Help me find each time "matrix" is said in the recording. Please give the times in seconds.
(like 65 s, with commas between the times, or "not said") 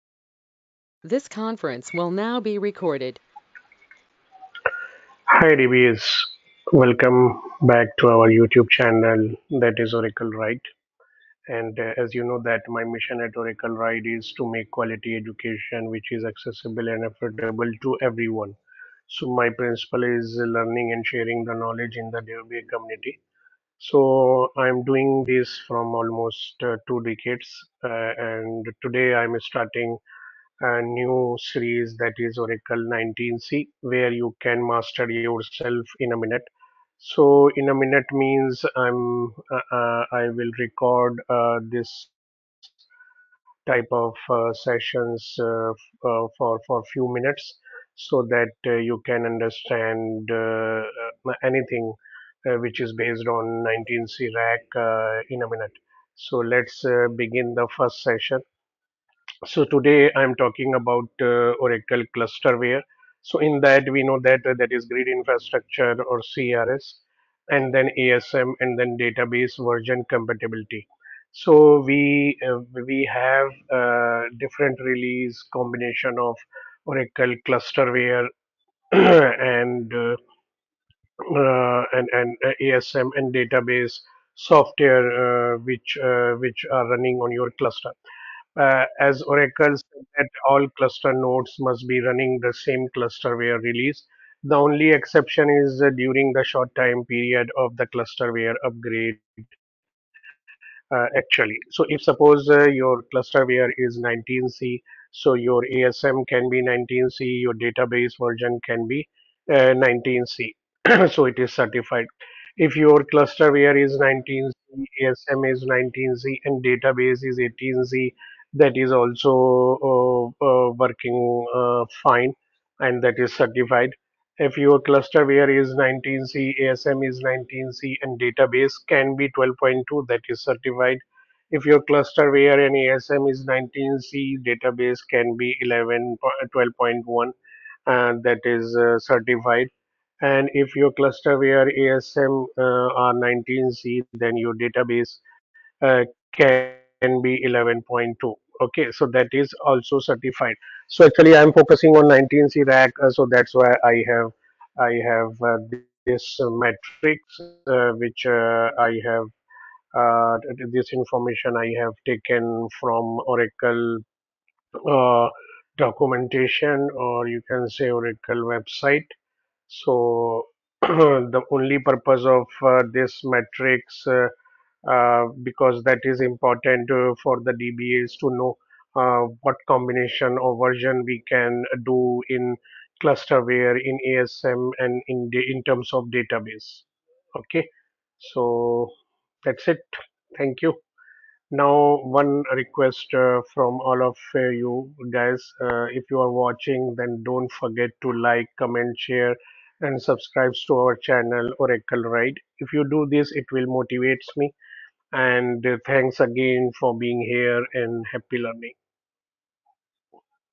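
156 s, 173 s.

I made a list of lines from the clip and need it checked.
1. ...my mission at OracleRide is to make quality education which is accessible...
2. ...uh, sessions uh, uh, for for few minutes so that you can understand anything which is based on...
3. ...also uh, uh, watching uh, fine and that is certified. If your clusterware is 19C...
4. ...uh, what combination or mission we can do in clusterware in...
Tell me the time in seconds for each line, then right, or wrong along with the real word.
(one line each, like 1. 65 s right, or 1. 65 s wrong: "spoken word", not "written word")
1. 12 s right
2. 44 s right
3. 118 s wrong: "working", not "watching"
4. 178 s wrong: "version", not "mission".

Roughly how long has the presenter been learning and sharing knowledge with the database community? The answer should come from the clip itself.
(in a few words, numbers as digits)
two decades.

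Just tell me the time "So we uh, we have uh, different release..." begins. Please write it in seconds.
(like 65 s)
71 s.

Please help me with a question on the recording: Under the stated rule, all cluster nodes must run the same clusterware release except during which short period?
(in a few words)
the clusterware upgrade.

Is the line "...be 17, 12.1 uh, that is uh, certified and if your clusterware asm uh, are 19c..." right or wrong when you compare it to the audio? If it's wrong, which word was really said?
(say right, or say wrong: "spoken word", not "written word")
wrong: "11", not "17".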